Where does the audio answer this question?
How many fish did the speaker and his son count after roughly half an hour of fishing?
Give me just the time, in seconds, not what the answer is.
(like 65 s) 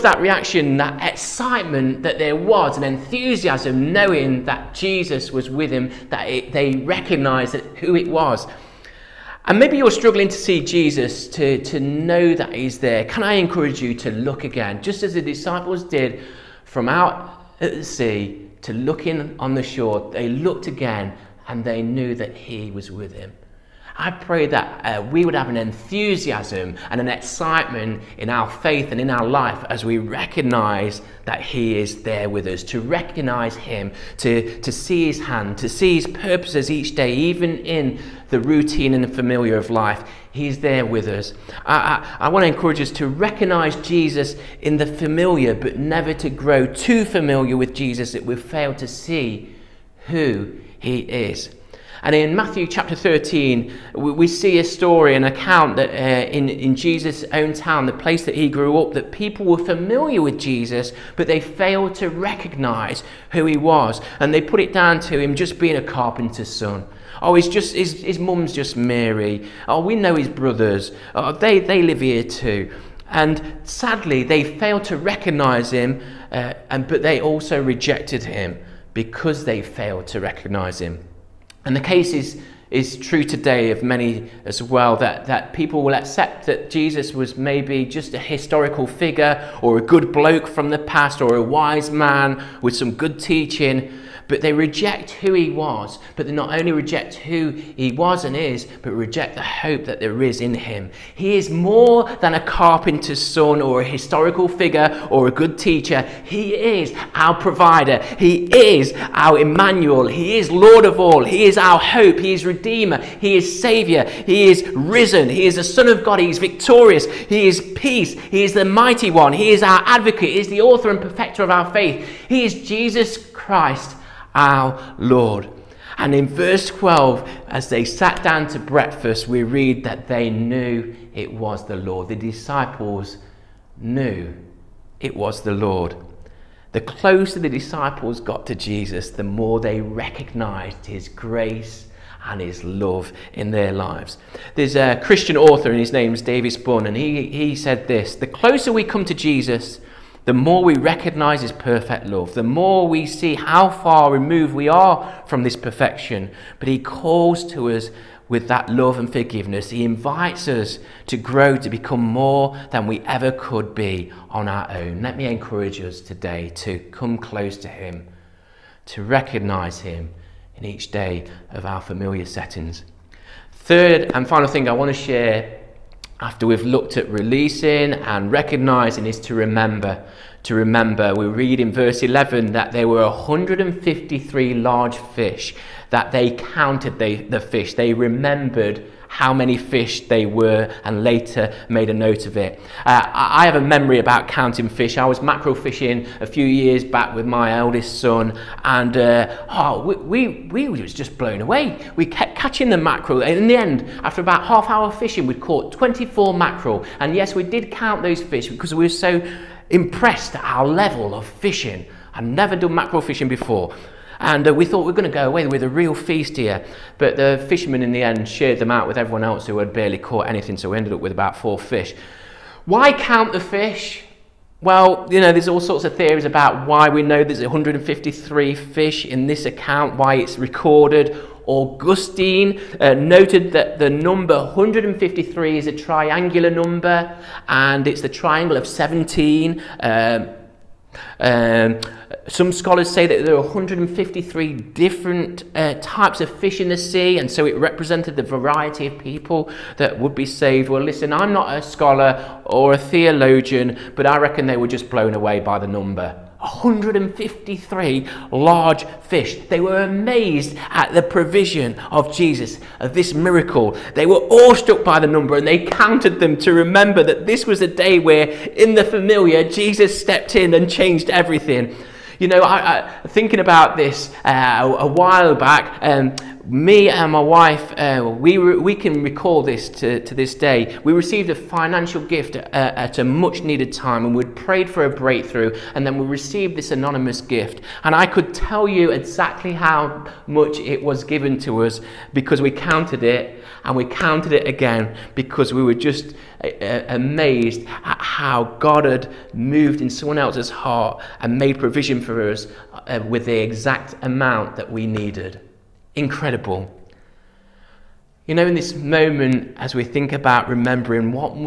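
205 s.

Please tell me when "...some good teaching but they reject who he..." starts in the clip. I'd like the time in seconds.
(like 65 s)
92 s.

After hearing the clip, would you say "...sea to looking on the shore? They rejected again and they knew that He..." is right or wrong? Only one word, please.
wrong.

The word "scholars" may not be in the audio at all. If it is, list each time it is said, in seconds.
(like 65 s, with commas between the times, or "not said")
242 s, 251 s.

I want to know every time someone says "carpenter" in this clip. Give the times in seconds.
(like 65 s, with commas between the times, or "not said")
65 s, 102 s.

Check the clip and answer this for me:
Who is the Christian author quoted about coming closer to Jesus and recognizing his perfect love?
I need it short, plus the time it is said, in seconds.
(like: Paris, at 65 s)
Davis Bunn, at 146 s.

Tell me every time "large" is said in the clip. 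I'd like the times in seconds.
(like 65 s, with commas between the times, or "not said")
184 s, 258 s.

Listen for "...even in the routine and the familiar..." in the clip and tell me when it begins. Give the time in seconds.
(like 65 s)
37 s.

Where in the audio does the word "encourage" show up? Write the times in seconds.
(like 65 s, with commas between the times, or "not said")
13 s, 42 s, 165 s.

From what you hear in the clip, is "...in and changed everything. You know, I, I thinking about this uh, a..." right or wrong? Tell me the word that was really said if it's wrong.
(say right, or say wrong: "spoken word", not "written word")
right.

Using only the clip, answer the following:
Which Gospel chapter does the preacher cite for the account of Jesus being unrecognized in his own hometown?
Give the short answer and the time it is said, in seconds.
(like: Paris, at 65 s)
Matthew 13, at 52 s.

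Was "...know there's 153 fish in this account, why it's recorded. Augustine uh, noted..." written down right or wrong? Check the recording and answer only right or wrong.
right.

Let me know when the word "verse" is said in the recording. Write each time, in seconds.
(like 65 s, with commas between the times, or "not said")
126 s, 181 s.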